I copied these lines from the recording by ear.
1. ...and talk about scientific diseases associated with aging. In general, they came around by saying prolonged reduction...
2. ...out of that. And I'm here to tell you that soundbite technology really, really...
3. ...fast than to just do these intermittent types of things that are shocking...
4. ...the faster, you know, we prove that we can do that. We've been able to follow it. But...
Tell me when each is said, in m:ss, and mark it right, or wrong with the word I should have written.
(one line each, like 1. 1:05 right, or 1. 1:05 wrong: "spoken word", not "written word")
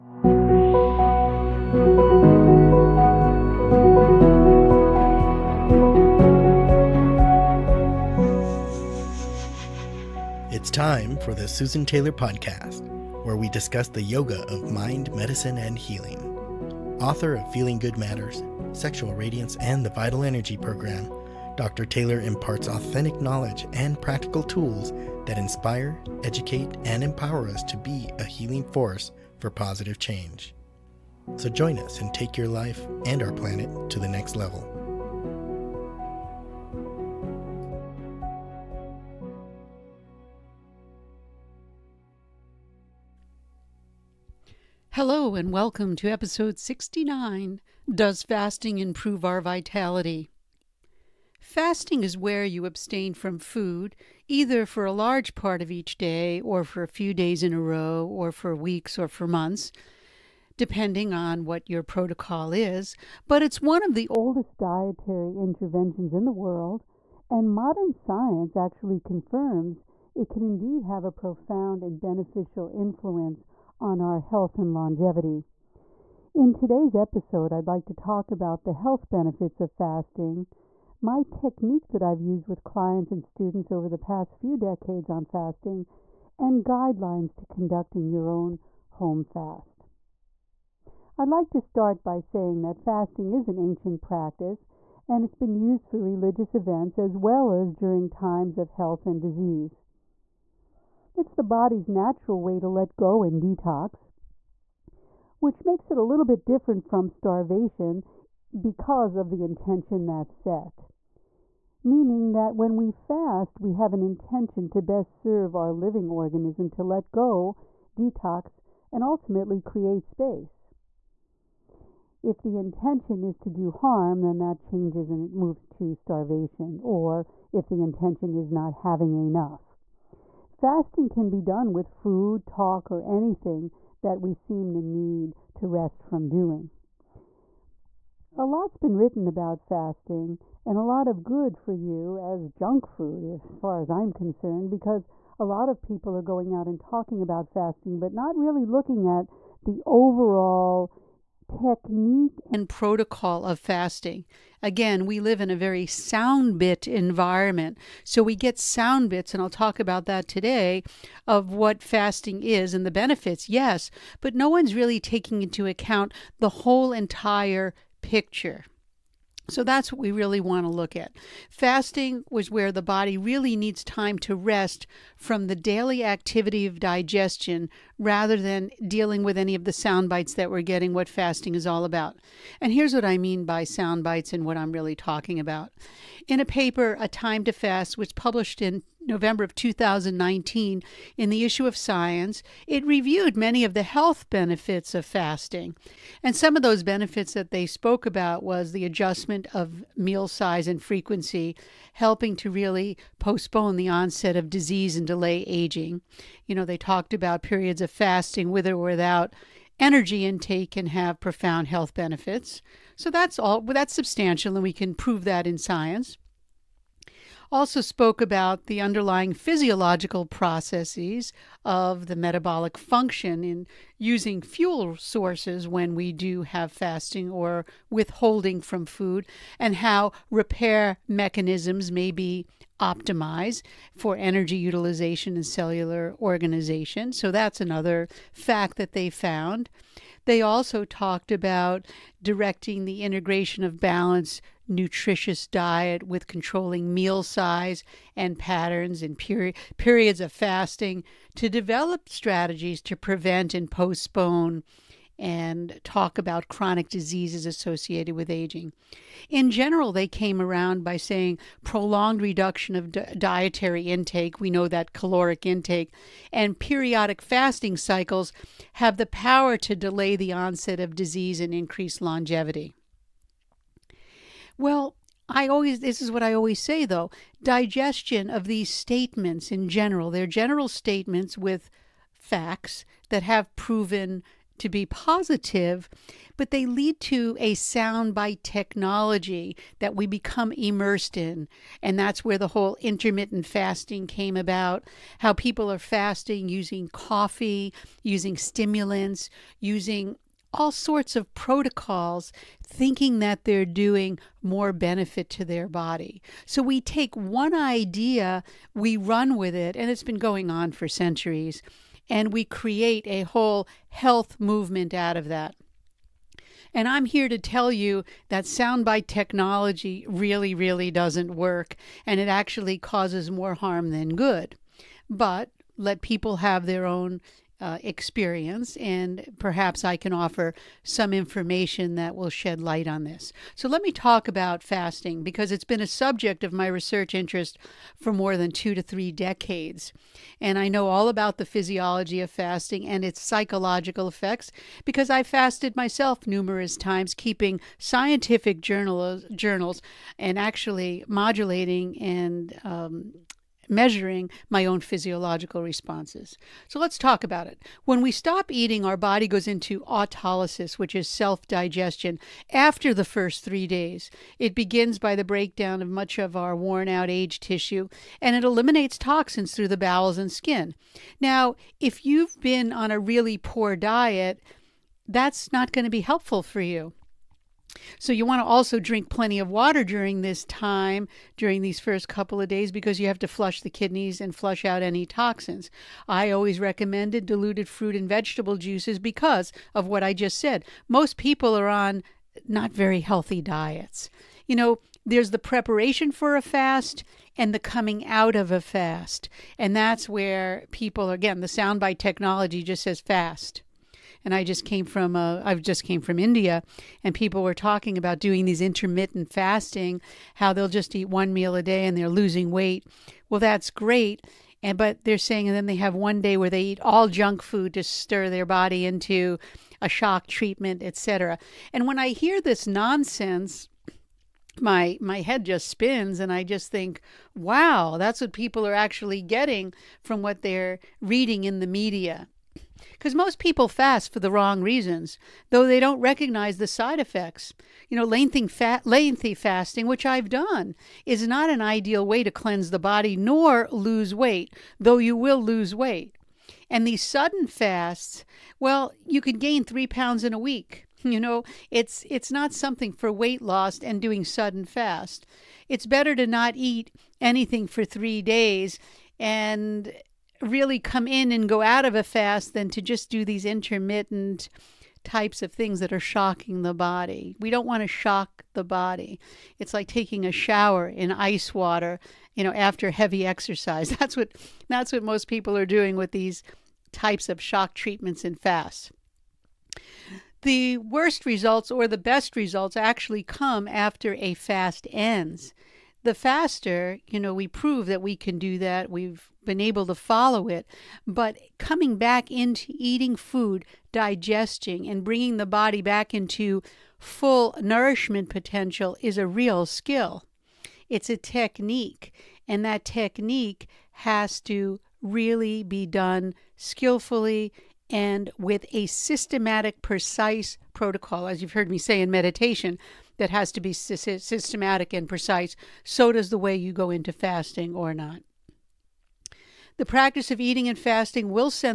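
1. 4:15 wrong: "chronic", not "scientific"
2. 5:14 right
3. 7:42 right
4. 8:06 right.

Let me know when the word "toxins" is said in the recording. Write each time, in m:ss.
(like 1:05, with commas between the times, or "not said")
6:08, 6:25.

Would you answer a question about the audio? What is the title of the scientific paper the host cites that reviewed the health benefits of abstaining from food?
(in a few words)
A Time to Fast.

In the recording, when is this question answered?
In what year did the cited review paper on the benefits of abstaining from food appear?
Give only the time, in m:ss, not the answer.
3:09.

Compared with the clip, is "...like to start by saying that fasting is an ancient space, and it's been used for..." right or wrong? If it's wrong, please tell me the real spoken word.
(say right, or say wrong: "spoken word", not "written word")
wrong: "practice", not "space".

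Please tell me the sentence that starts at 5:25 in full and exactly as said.
But let people have their own uh, experience, and perhaps I can offer some information that will shed light on this.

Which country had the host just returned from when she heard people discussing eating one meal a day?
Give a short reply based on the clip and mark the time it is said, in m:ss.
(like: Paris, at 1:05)
India, at 6:46.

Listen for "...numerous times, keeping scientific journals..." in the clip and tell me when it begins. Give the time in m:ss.
5:46.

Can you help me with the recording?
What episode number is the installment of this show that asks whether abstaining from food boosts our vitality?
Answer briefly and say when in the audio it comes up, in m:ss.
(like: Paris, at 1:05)
69, at 0:46.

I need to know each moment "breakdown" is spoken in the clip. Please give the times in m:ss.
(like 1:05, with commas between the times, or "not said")
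6:05.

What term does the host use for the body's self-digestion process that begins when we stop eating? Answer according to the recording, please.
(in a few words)
autolysis.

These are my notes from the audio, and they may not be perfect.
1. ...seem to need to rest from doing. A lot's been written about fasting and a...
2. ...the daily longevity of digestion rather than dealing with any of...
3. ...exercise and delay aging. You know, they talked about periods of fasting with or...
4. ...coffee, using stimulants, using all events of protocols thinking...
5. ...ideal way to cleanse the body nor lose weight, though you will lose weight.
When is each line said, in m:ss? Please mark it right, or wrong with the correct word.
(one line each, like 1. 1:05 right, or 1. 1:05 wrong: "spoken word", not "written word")
1. 2:14 right
2. 2:55 wrong: "activity", not "longevity"
3. 3:24 wrong: "disease", not "exercise"
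4. 4:56 wrong: "sorts", not "events"
5. 7:21 right.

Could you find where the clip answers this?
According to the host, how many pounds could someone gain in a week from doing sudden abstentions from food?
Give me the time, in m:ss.
7:29.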